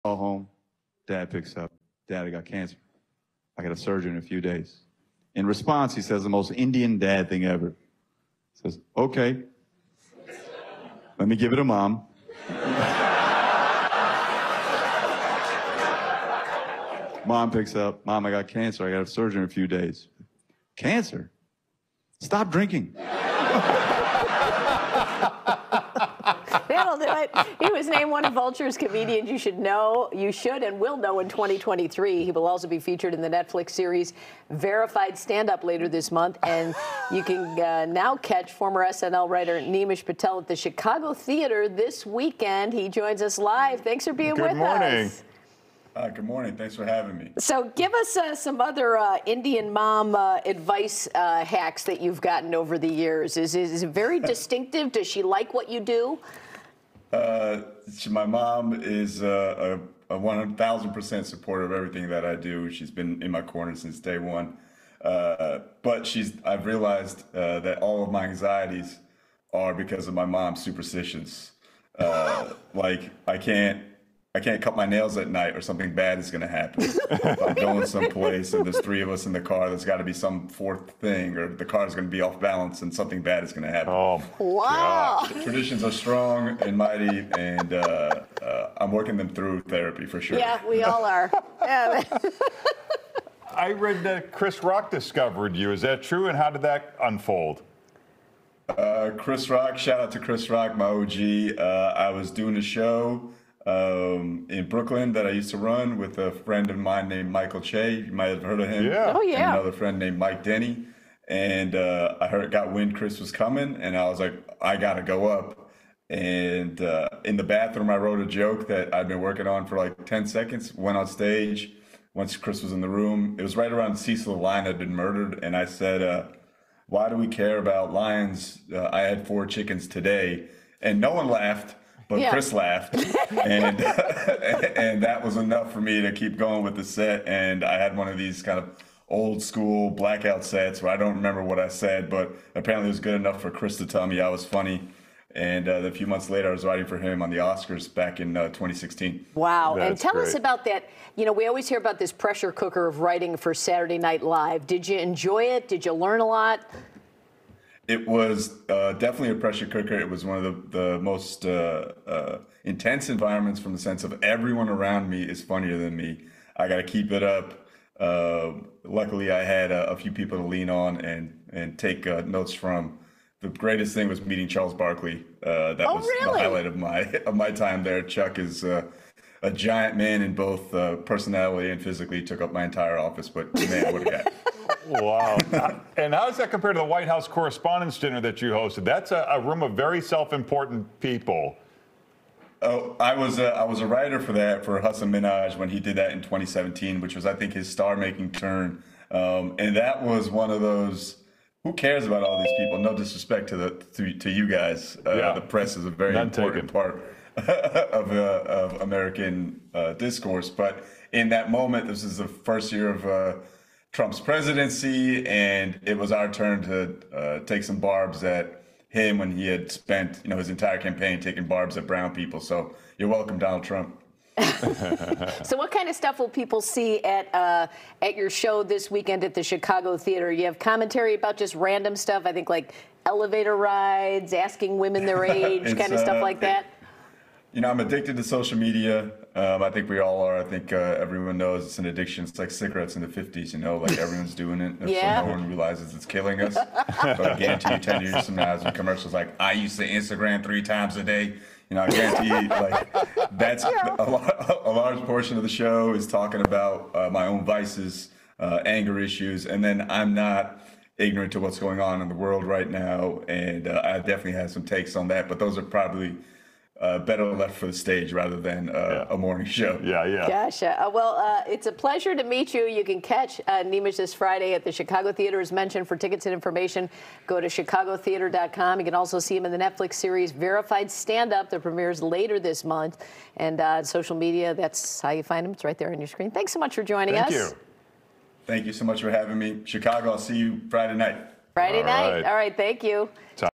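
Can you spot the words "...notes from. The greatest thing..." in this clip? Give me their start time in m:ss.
2:52.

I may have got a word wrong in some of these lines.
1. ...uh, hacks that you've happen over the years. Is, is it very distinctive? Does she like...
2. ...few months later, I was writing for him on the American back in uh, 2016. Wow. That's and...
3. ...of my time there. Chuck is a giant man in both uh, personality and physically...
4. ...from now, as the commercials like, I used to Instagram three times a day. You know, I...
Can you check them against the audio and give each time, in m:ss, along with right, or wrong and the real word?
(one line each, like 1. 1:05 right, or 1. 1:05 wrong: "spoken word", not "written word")
1. 0:51 wrong: "gotten", not "happen"
2. 2:25 wrong: "Oscars", not "American"
3. 2:57 right
4. 4:08 right.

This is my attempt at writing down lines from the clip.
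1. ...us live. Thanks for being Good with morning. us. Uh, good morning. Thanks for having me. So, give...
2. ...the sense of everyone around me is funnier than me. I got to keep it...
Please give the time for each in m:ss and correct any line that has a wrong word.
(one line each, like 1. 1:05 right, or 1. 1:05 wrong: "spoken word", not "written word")
1. 0:43 right
2. 2:43 right.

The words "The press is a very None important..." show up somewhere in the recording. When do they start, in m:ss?
3:25.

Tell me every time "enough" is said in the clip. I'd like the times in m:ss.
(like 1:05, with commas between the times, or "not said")
2:15, 2:23.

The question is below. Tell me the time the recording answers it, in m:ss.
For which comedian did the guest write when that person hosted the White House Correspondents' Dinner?
3:14.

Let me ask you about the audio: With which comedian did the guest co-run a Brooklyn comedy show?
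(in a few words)
Michael Che.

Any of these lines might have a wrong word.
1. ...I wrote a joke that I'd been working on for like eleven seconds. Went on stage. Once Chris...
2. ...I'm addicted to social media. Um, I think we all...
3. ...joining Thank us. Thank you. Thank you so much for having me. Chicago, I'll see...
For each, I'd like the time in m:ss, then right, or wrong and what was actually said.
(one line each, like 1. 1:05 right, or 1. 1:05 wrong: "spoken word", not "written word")
1. 1:57 wrong: "ten", not "eleven"
2. 3:57 right
3. 4:46 right.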